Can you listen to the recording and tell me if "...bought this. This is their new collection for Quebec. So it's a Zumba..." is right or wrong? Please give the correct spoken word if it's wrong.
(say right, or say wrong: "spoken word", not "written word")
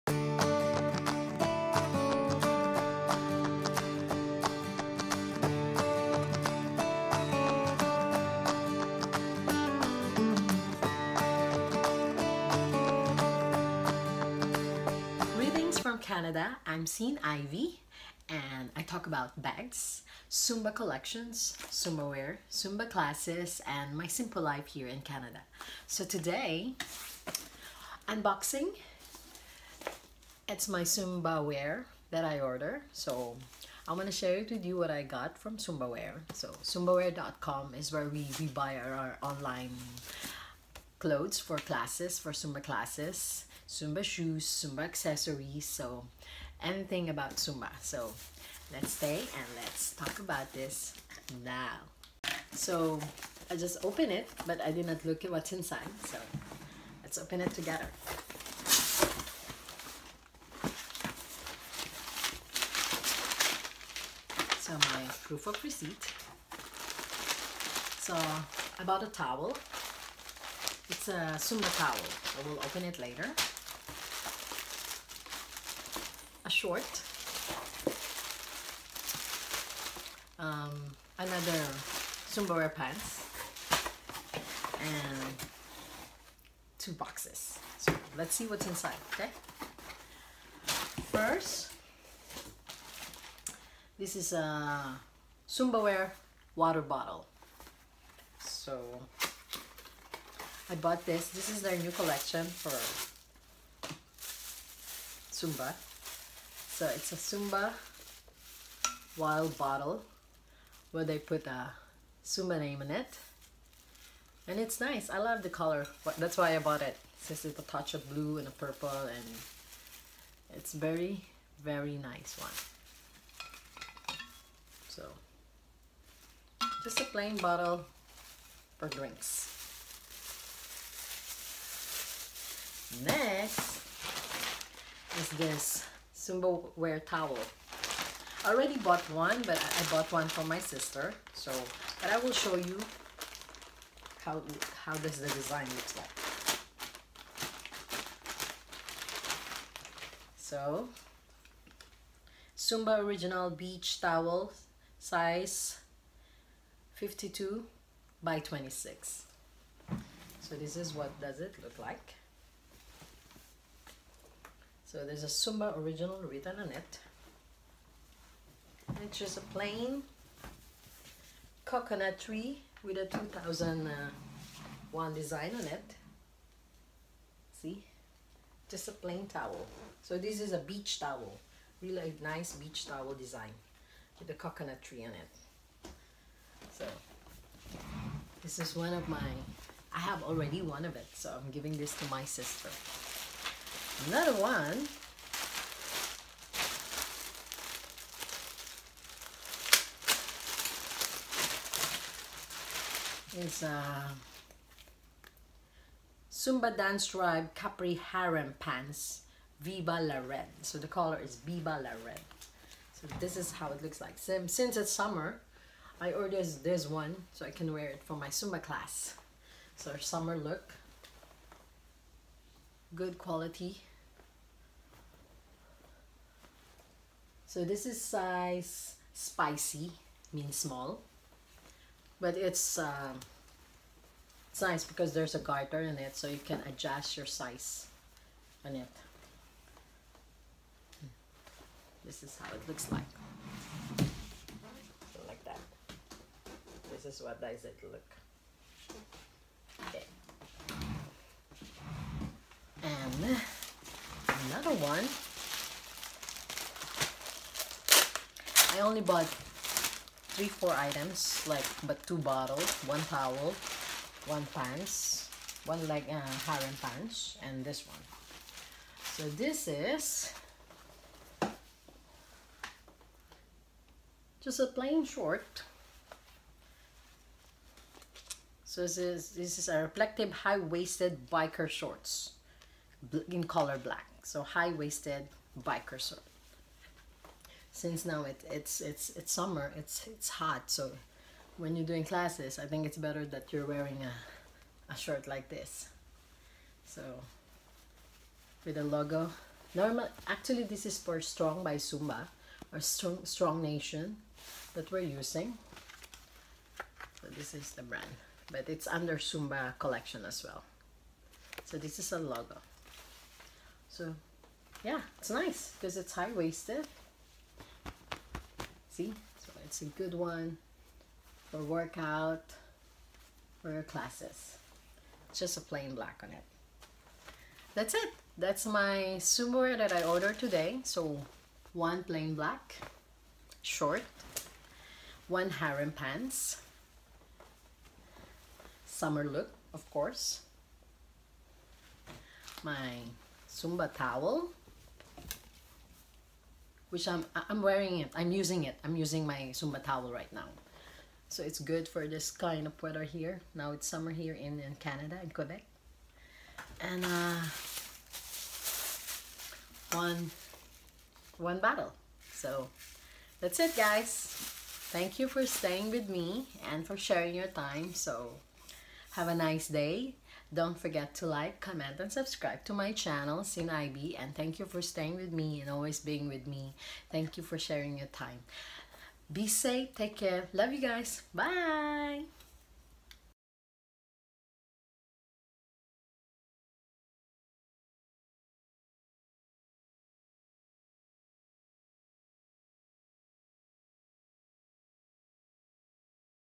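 wrong: "Zumba", not "Quebec".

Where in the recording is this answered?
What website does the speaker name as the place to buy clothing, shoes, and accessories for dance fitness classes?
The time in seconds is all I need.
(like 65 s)
36 s.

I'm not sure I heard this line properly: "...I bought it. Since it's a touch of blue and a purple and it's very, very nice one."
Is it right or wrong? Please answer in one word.
right.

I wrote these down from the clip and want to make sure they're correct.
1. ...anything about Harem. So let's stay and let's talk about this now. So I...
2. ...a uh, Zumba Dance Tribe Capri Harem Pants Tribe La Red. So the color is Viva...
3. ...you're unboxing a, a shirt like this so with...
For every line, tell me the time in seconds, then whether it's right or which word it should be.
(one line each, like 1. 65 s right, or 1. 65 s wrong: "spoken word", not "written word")
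1. 46 s wrong: "Zumba", not "Harem"
2. 203 s wrong: "Viva", not "Tribe"
3. 293 s wrong: "wearing", not "unboxing".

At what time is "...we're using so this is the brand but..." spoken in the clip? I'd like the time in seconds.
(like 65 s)
304 s.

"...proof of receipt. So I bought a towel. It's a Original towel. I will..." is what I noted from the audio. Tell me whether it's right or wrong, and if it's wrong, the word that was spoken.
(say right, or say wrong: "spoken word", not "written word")
wrong: "Zumba", not "Original".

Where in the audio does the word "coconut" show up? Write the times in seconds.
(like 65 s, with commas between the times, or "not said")
171 s, 184 s.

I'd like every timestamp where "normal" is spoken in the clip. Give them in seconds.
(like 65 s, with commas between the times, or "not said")
299 s.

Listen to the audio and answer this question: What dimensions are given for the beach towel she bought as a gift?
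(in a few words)
52 by 26.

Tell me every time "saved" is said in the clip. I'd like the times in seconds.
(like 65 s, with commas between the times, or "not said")
not said.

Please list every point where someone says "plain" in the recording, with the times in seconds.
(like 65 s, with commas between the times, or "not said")
127 s, 169 s, 178 s, 274 s, 325 s, 332 s.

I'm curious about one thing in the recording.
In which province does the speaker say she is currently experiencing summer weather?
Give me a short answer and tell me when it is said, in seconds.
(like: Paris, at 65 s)
Quebec, at 355 s.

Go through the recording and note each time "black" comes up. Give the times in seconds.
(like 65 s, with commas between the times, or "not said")
283 s, 325 s, 332 s.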